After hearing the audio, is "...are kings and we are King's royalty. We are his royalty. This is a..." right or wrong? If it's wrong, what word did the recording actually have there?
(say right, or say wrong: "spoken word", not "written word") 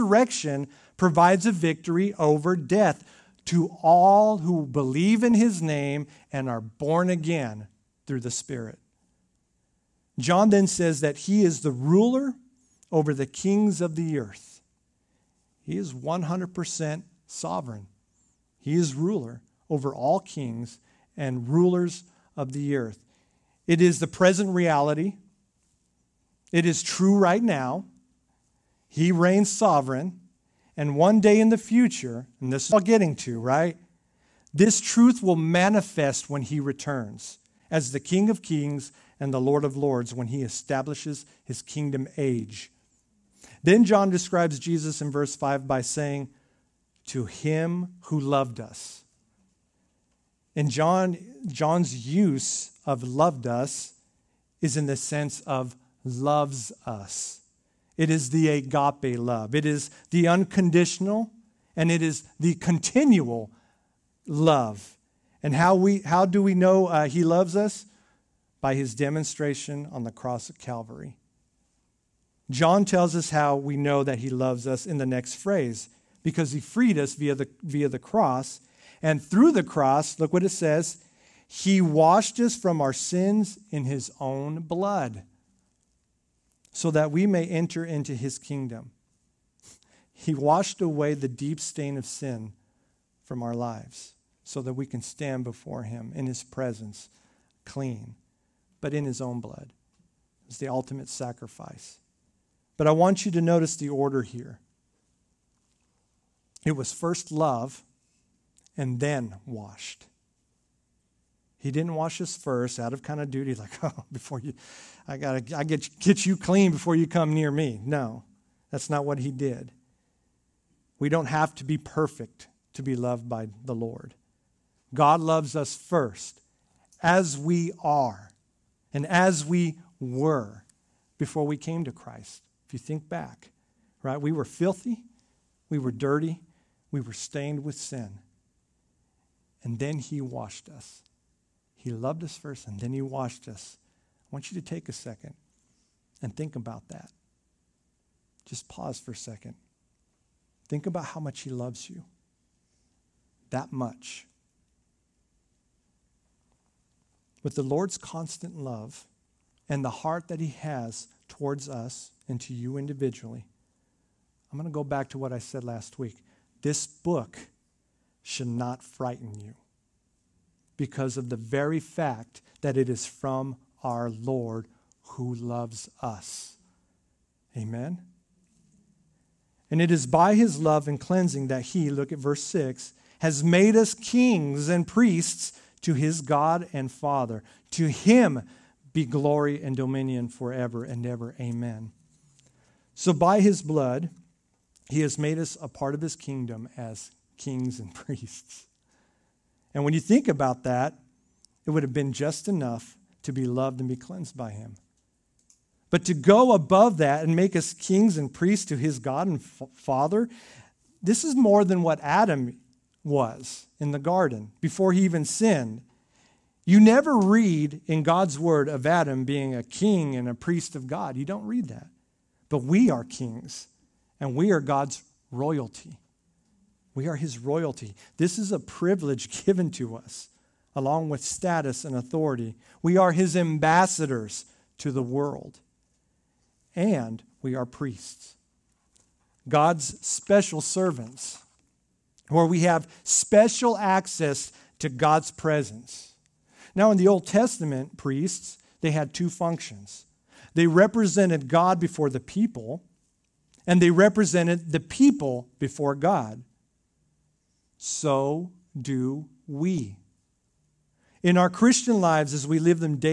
wrong: "God", not "King".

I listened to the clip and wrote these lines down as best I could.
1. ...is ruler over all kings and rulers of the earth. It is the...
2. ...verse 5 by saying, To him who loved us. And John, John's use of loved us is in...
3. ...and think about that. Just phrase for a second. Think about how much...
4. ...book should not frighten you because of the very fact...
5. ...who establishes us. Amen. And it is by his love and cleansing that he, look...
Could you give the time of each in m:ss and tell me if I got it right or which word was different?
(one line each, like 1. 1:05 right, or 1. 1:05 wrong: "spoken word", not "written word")
1. 0:18 right
2. 0:45 right
3. 2:26 wrong: "pause", not "phrase"
4. 2:46 right
5. 2:55 wrong: "loves", not "establishes".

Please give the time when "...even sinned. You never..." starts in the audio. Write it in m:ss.
3:35.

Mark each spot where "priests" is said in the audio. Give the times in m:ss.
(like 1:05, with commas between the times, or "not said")
3:04, 3:17, 3:28, 3:40, 3:57, 4:07.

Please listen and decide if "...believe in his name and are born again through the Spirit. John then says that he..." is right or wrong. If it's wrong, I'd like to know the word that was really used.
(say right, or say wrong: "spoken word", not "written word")
right.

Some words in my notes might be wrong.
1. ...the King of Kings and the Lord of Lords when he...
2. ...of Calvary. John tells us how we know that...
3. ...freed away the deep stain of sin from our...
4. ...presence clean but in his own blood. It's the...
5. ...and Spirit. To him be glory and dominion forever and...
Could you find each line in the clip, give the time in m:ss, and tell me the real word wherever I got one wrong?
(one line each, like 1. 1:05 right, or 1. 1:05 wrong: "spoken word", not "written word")
1. 0:37 right
2. 1:10 right
3. 1:30 wrong: "washed", not "freed"
4. 1:36 right
5. 3:06 wrong: "Father", not "Spirit".